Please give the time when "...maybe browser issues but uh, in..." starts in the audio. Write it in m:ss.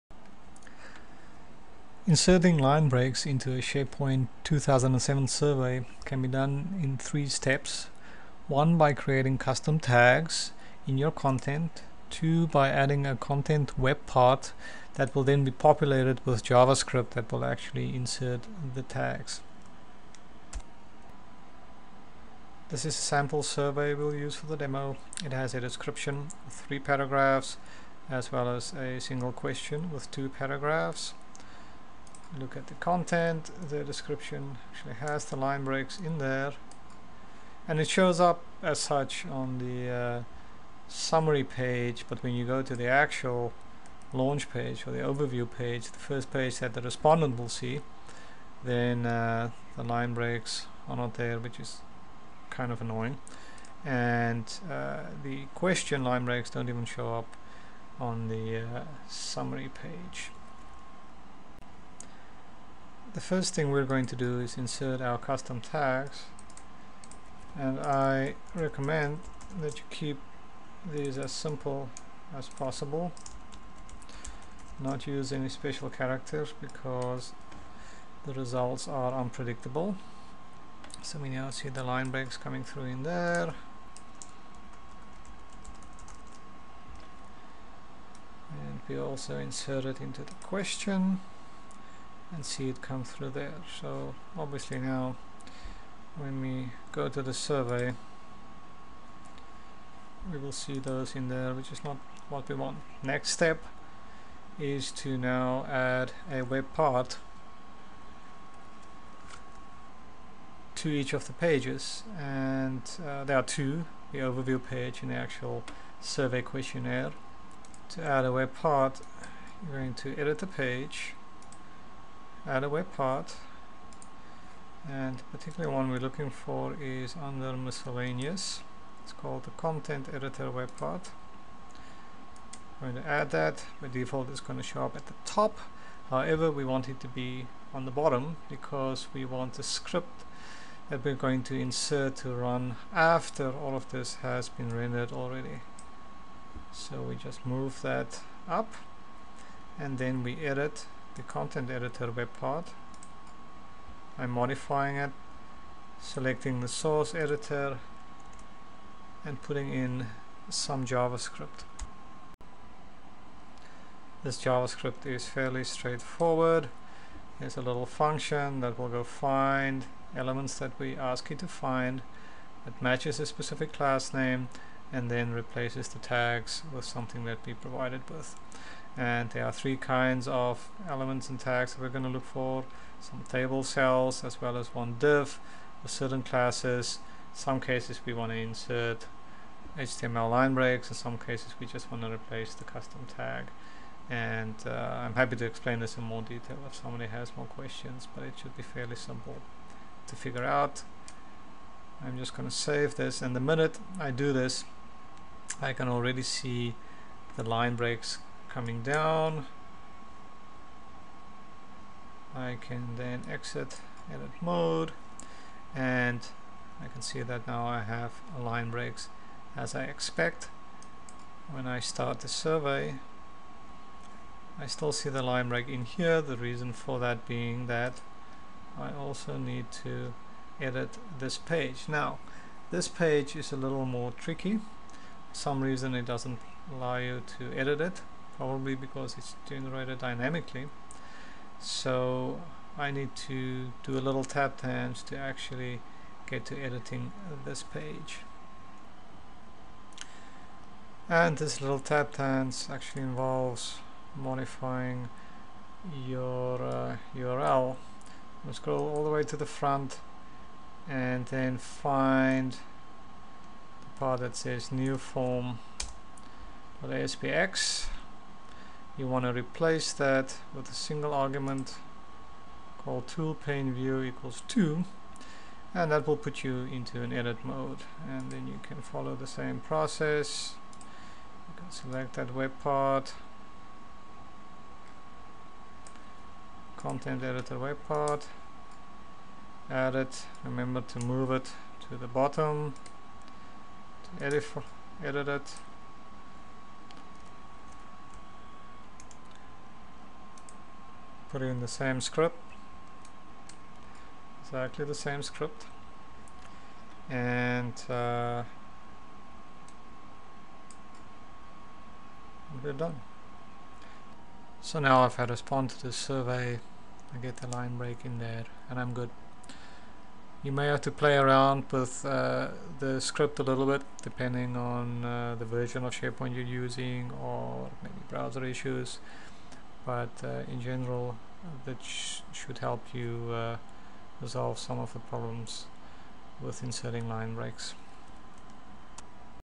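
5:27.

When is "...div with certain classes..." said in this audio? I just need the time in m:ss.
3:04.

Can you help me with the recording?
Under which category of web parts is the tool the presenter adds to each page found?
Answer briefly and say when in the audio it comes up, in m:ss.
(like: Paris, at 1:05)
Miscellaneous, at 2:07.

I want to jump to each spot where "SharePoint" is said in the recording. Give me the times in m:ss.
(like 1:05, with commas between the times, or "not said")
0:03, 5:25.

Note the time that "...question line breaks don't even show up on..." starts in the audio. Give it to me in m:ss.
0:55.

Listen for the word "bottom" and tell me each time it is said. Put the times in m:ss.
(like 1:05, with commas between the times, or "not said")
2:17, 4:52.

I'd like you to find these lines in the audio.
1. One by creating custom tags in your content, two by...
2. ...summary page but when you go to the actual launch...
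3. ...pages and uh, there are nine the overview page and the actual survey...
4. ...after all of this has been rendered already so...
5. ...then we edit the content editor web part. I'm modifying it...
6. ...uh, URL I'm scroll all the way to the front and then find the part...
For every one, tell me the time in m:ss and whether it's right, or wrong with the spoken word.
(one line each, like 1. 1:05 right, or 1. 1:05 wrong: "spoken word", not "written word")
1. 0:08 right
2. 0:40 right
3. 1:51 wrong: "two", not "nine"
4. 2:22 right
5. 2:29 right
6. 4:16 right.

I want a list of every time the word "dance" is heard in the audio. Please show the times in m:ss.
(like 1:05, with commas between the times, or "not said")
4:04, 4:12.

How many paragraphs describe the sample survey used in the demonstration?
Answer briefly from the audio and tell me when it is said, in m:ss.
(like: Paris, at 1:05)
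3, at 0:26.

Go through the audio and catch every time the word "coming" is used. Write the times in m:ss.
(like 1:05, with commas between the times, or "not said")
1:22, 3:28.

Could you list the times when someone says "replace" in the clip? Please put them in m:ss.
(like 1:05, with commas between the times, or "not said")
2:55, 3:12, 4:29.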